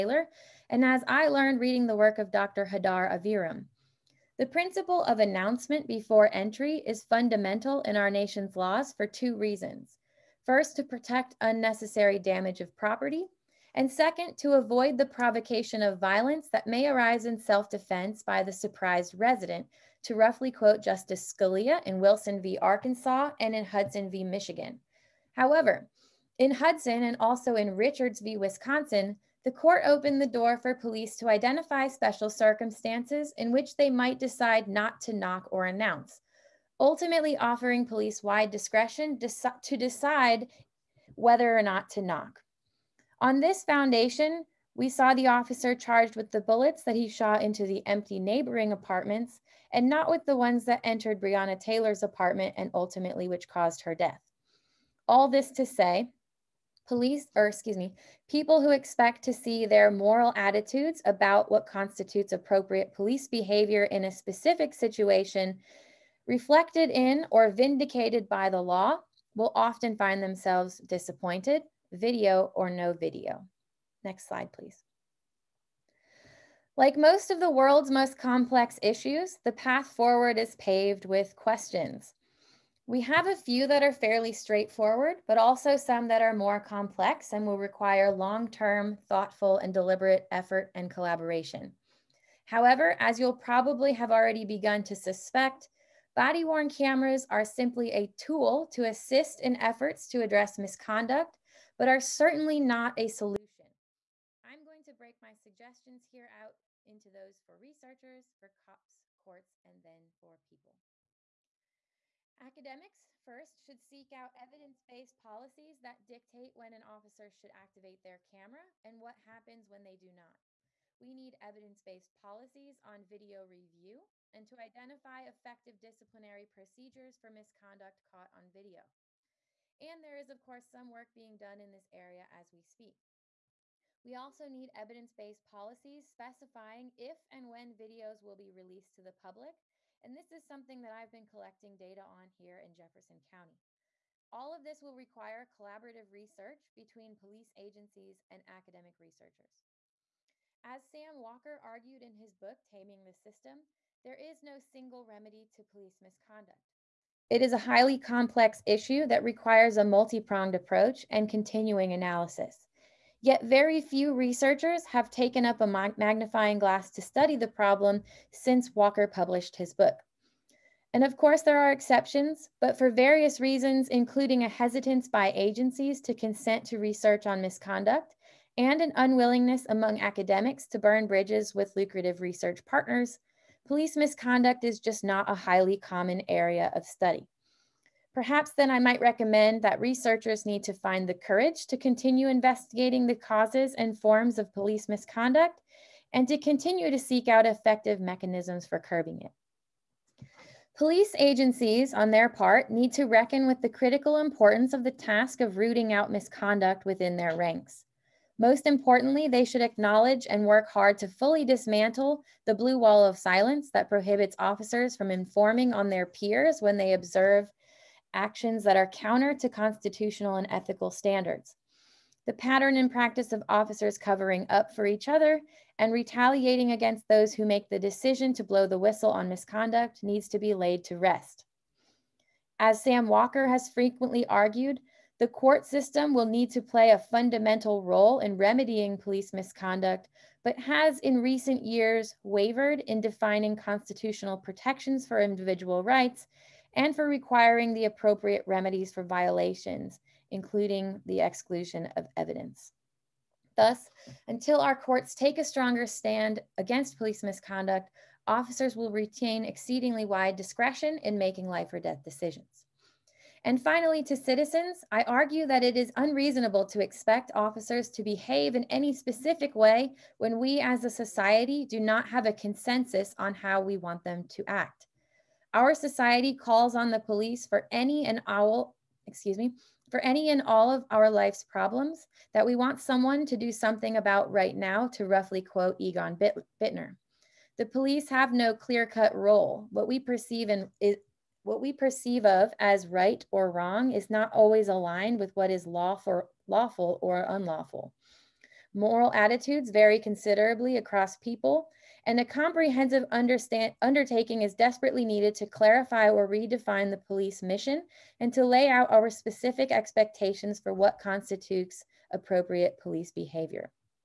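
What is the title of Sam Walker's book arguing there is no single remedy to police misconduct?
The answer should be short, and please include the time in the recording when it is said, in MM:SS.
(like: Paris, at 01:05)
Taming the System, at 02:32.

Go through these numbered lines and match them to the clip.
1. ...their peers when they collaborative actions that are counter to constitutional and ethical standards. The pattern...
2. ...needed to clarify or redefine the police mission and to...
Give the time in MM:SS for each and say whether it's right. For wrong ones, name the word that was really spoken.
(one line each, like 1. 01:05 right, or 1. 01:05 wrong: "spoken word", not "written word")
1. 03:35 wrong: "observe", not "collaborative"
2. 05:05 right.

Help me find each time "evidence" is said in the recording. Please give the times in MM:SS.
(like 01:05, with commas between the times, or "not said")
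01:54, 02:01, 02:14, 04:12.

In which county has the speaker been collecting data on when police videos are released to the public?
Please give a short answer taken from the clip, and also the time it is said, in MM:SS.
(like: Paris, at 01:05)
Jefferson County, at 02:22.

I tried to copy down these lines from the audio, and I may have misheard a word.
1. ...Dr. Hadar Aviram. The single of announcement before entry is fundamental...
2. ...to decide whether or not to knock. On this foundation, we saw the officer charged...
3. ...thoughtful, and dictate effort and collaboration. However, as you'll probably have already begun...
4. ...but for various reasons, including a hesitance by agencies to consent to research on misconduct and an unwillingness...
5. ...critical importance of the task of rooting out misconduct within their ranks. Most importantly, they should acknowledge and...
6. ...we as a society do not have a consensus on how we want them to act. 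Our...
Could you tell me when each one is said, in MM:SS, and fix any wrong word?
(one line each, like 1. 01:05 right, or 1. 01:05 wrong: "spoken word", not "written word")
1. 00:02 wrong: "principle", not "single"
2. 00:39 right
3. 01:29 wrong: "deliberate", not "dictate"
4. 02:52 right
5. 03:23 right
6. 04:30 right.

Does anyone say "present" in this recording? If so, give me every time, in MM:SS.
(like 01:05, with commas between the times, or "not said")
not said.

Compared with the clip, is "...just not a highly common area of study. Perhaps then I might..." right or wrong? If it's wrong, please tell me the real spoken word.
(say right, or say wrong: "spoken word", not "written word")
right.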